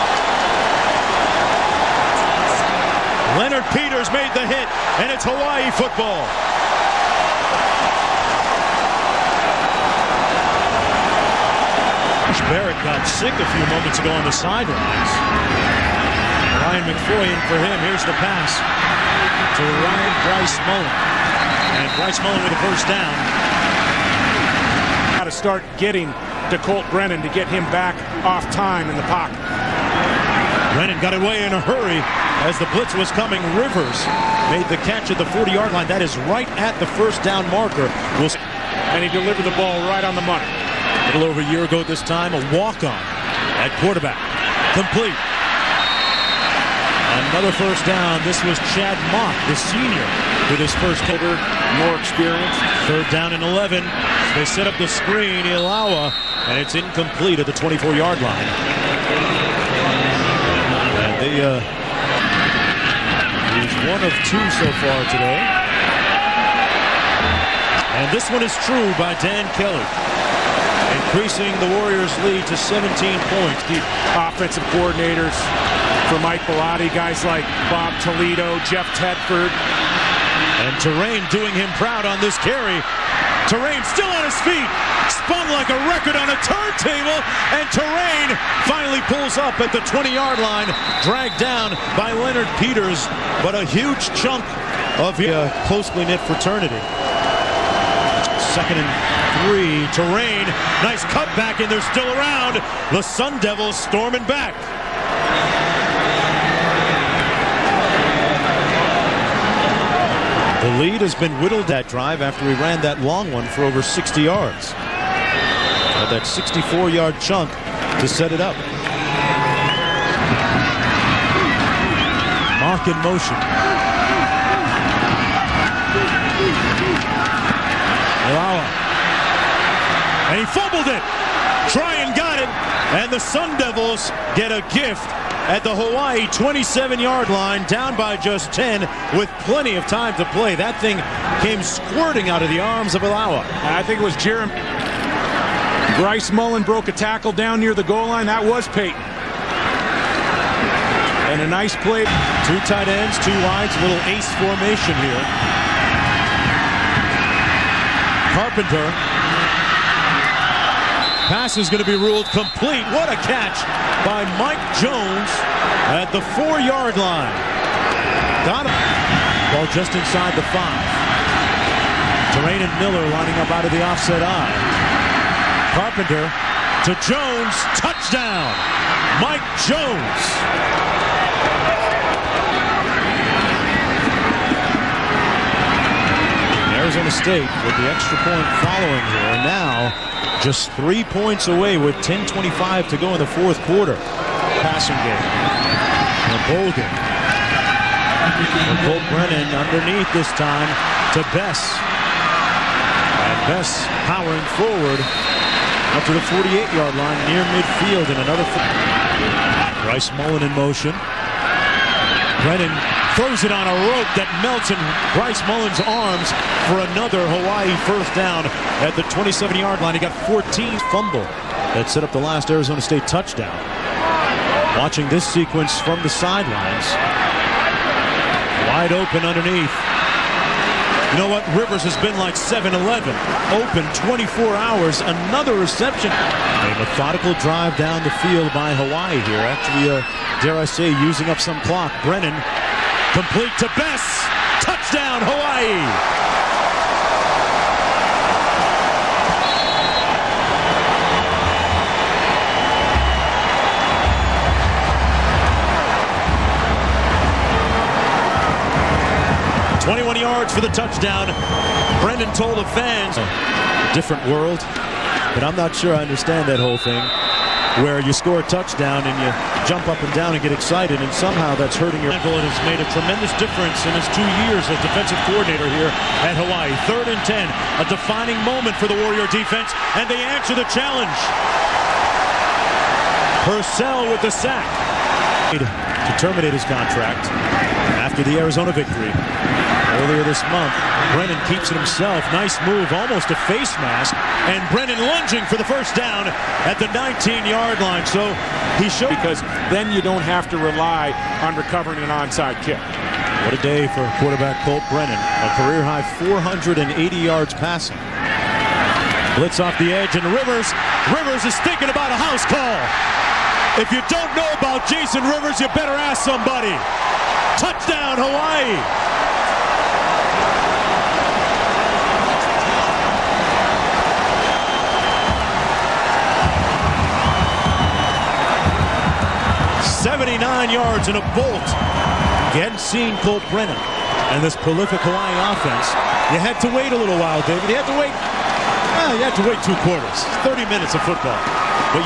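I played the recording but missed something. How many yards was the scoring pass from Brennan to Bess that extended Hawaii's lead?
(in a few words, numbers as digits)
21.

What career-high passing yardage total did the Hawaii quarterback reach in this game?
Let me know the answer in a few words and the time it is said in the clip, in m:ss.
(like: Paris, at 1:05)
480 yards, at 5:06.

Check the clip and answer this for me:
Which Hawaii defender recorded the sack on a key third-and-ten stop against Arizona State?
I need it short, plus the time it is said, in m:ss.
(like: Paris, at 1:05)
Purcell, at 4:43.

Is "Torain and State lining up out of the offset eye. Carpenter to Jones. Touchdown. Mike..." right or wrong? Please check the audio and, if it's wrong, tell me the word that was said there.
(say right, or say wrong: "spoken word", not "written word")
wrong: "Miller", not "State".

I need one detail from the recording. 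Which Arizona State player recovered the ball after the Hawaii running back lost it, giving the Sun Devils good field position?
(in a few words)
Tryon.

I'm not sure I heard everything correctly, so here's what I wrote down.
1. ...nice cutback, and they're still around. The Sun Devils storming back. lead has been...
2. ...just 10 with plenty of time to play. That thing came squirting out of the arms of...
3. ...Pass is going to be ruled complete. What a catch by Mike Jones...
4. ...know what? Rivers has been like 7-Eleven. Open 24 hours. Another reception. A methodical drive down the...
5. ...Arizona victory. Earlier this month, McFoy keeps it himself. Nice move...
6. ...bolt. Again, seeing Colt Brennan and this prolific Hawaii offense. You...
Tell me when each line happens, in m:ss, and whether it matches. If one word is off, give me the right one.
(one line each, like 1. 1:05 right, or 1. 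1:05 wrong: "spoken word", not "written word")
1. 1:40 right
2. 2:18 right
3. 2:41 right
4. 3:51 right
5. 4:48 wrong: "Brennan", not "McFoy"
6. 5:31 right.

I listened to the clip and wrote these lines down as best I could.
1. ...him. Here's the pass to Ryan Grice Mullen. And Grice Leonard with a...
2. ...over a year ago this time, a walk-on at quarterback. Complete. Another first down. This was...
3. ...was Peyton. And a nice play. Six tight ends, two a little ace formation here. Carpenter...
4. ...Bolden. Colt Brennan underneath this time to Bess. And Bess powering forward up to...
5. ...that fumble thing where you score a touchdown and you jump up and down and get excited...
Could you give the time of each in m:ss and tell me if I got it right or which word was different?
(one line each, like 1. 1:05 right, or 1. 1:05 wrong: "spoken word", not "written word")
1. 0:17 wrong: "Mullen", not "Leonard"
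2. 0:41 right
3. 2:28 wrong: "Two", not "Six"
4. 3:16 right
5. 4:26 wrong: "whole", not "fumble".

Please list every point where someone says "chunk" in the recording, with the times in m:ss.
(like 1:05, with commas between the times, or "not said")
1:34, 1:57.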